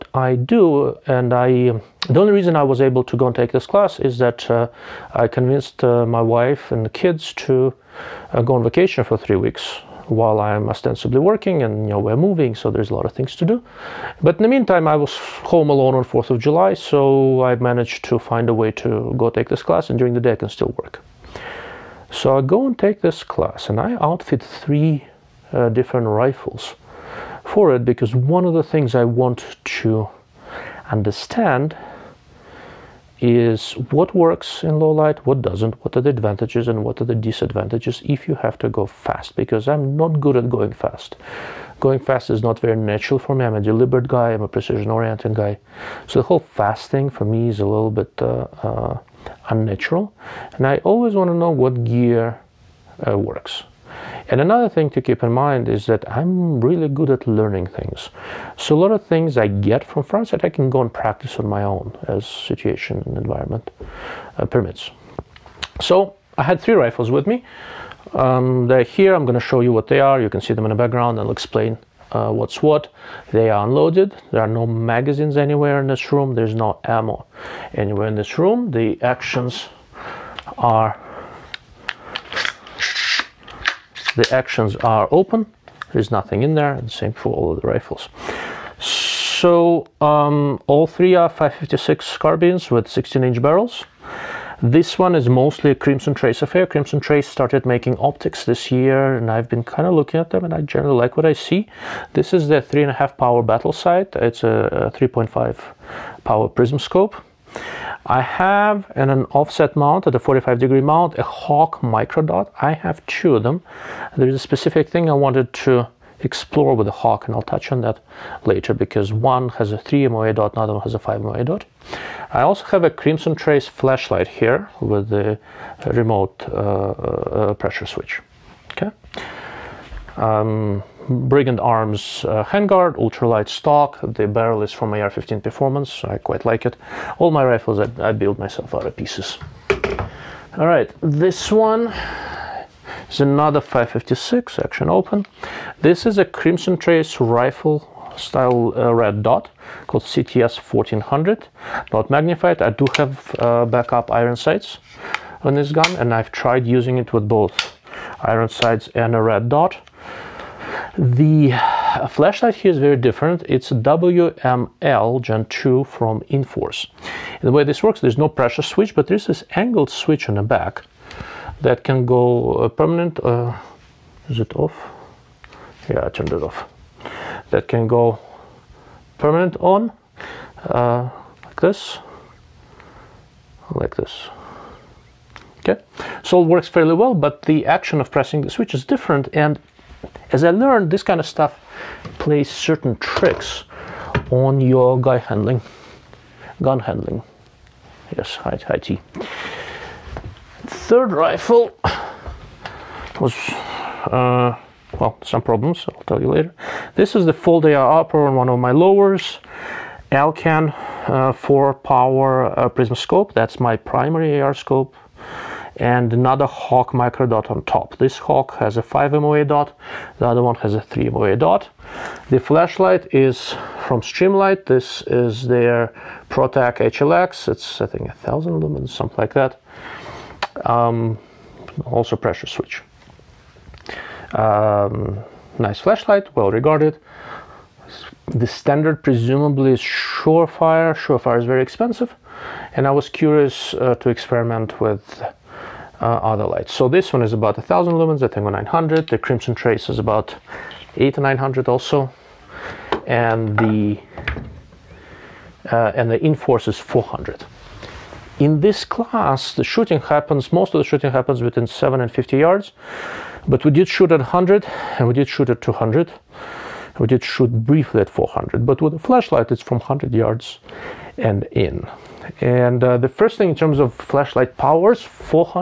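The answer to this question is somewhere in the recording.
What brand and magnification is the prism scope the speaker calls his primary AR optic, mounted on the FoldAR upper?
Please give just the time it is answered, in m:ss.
3:30.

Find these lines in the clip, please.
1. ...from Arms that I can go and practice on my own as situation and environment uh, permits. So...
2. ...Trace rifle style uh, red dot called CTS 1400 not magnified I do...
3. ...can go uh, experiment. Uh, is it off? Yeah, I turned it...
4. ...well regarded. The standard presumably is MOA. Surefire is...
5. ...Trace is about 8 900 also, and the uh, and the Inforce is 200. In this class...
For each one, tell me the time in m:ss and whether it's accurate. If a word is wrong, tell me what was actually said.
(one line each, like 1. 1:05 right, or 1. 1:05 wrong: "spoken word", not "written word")
1. 0:59 wrong: "Frontsight", not "Arms"
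2. 2:26 right
3. 2:51 wrong: "permanent", not "experiment"
4. 3:56 wrong: "Surefire", not "MOA"
5. 4:09 wrong: "400", not "200".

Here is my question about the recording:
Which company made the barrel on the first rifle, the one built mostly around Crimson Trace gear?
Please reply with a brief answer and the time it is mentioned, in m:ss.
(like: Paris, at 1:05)
AR-15 Performance, at 2:14.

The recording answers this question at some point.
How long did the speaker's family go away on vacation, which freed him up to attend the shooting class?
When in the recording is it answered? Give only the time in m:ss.
0:09.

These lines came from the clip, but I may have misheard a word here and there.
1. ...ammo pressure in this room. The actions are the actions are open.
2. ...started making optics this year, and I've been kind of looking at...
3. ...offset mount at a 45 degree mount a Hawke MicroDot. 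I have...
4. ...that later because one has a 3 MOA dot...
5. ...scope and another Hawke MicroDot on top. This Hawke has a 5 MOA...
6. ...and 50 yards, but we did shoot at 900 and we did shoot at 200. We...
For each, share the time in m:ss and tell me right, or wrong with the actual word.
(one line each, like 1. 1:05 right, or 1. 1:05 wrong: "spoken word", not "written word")
1. 1:16 wrong: "anywhere", not "pressure"
2. 1:37 right
3. 1:49 right
4. 1:57 right
5. 3:34 right
6. 4:22 wrong: "100", not "900".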